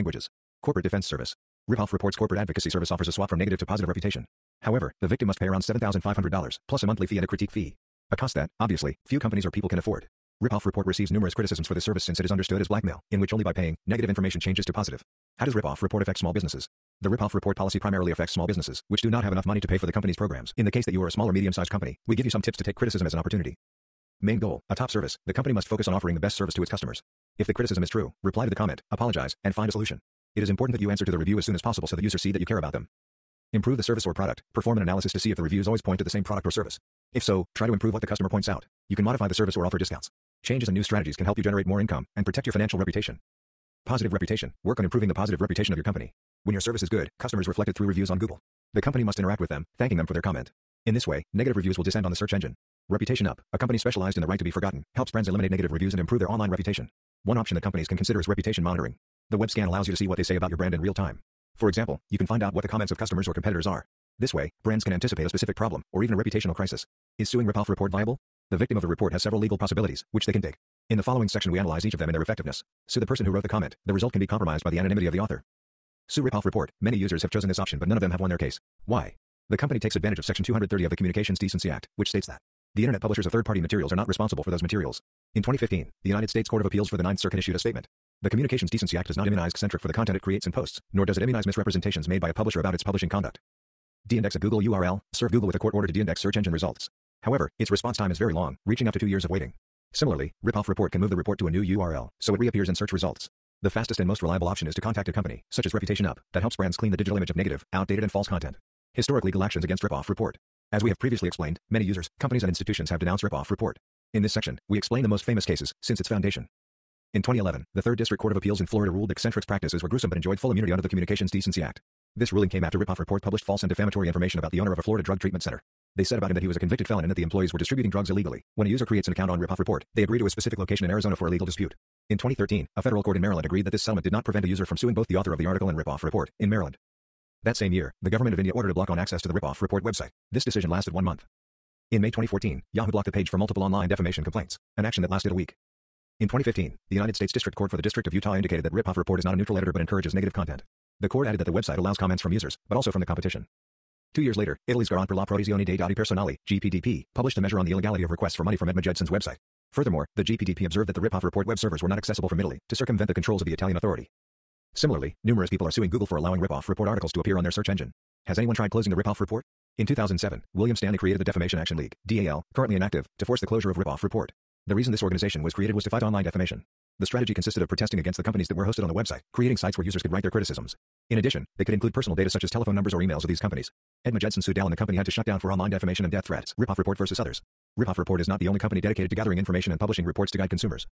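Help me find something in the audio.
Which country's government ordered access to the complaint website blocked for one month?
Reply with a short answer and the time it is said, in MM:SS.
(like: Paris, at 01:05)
India, at 02:18.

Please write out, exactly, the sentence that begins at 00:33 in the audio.
Improve the service or product, Perform an analysis to see if the reviews always point to the same product or service.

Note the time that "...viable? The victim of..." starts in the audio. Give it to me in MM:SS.
01:07.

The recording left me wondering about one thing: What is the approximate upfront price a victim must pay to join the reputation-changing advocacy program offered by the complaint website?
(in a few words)
$7,500.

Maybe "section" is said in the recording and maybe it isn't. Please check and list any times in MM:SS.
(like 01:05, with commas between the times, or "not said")
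01:11, 01:20, 01:54.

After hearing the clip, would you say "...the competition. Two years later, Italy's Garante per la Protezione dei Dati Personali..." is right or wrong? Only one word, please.
right.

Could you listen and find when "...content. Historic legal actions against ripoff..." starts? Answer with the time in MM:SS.
01:48.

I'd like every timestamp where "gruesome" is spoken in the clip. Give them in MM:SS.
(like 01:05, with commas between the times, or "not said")
01:59.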